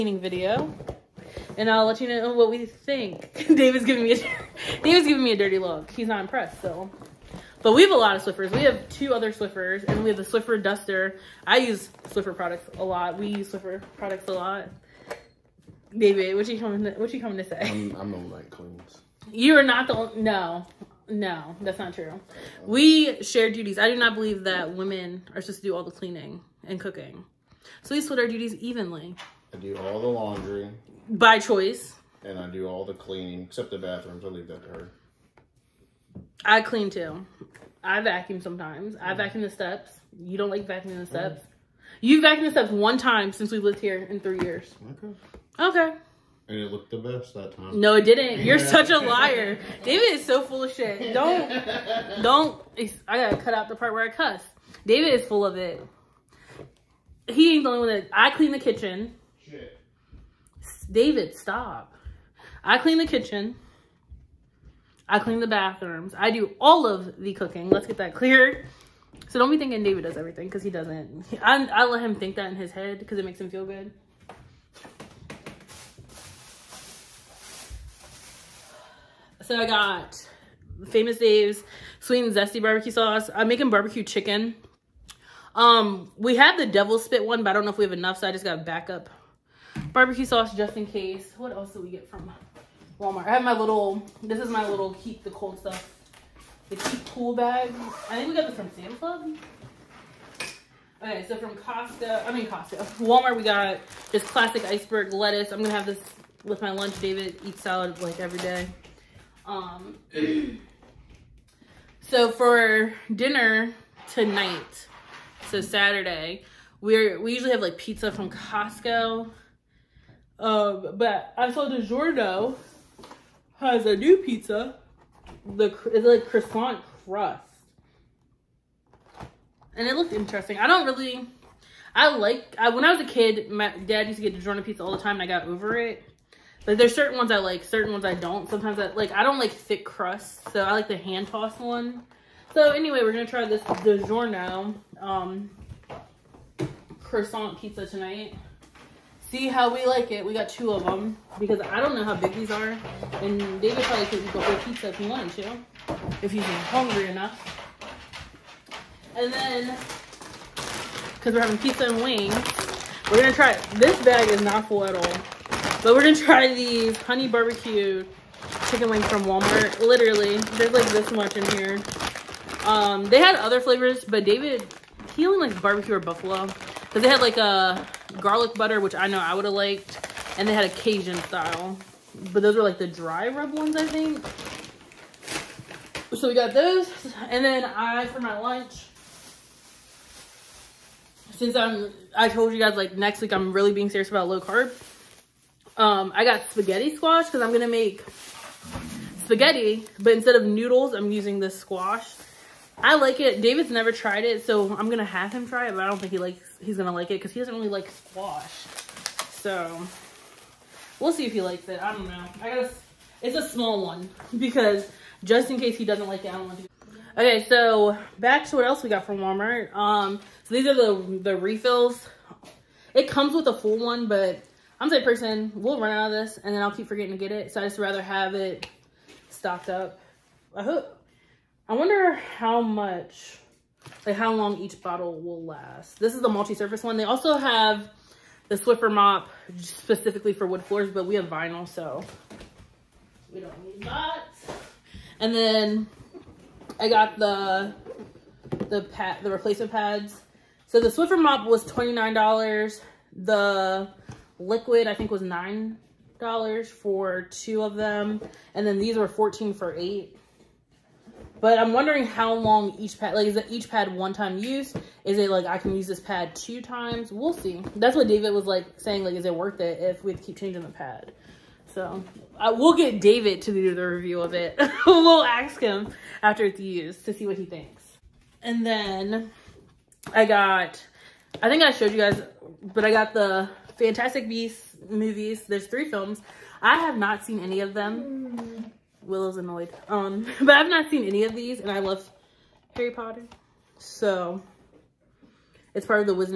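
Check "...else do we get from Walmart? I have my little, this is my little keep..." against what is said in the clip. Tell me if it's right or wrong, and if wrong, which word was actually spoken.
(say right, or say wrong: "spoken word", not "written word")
right.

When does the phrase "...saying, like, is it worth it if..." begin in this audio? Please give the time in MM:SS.
04:28.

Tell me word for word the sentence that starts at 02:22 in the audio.
So anyway, we're gonna try this DiGiorno um, croissant pizza tonight.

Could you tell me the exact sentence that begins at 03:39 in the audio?
Um, so these are the the refills.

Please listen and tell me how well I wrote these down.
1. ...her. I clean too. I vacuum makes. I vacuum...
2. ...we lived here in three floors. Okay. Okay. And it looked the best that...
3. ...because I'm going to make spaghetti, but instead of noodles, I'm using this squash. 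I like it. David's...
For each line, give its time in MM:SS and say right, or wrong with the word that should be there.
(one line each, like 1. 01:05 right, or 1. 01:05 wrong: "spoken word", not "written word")
1. 00:34 wrong: "sometimes", not "makes"
2. 00:43 wrong: "years", not "floors"
3. 03:17 right.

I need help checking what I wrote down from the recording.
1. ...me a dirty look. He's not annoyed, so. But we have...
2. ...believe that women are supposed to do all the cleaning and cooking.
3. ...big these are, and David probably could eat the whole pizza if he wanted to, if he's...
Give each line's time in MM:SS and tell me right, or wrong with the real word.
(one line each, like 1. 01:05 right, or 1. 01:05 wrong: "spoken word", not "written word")
1. 00:05 wrong: "impressed", not "annoyed"
2. 00:24 right
3. 02:32 right.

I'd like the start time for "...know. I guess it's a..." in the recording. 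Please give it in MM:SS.
03:32.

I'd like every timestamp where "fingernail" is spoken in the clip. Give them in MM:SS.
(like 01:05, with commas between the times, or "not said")
not said.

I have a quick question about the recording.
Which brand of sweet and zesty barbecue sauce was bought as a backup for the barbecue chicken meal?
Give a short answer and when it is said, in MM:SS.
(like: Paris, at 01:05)
Famous Dave's, at 01:20.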